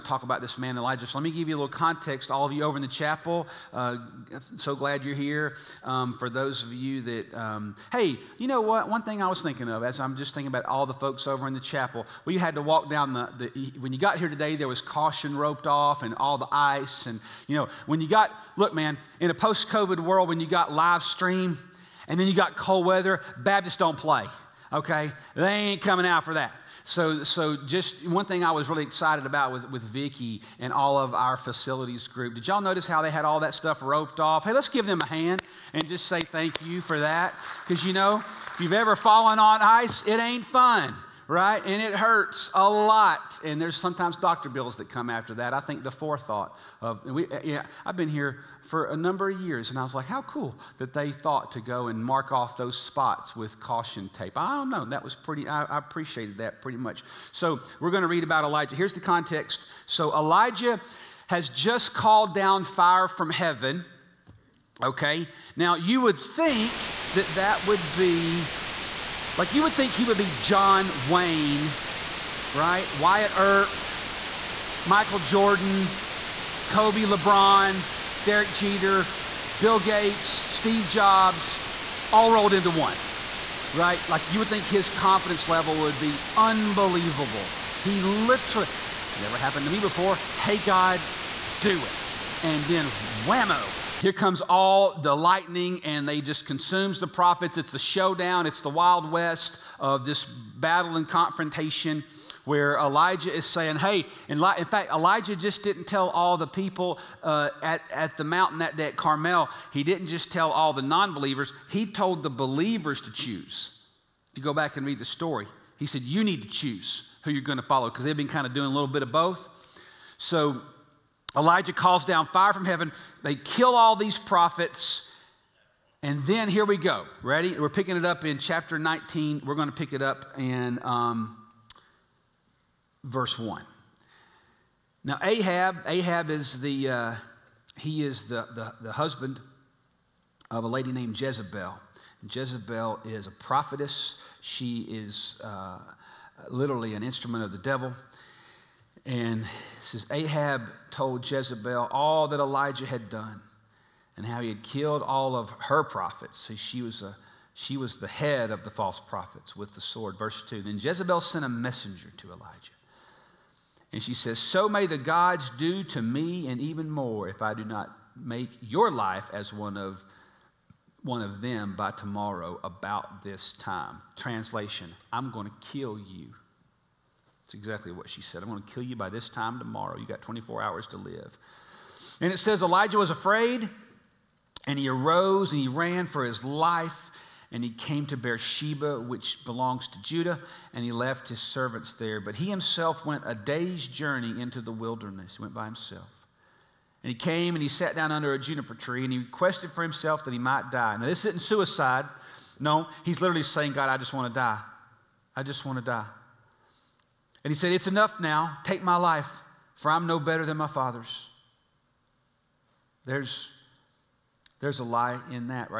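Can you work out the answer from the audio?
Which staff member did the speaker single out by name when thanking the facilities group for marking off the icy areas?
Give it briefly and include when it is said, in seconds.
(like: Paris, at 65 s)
Vicky, at 29 s.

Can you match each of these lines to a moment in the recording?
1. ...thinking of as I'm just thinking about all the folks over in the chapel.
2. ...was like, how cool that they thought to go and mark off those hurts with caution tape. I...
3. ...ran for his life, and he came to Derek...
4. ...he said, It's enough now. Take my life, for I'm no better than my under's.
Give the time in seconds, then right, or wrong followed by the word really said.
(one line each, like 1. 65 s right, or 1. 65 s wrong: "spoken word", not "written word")
1. 9 s right
2. 49 s wrong: "spots", not "hurts"
3. 185 s wrong: "Beersheba", not "Derek"
4. 207 s wrong: "father", not "under".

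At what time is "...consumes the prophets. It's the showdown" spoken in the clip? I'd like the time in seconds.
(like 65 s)
96 s.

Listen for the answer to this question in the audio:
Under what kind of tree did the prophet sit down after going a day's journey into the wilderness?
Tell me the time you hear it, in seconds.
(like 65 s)
198 s.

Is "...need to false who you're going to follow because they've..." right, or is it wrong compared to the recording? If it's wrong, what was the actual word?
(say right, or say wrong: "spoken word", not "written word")
wrong: "choose", not "false".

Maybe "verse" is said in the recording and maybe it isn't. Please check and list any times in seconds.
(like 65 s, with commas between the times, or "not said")
133 s, 160 s.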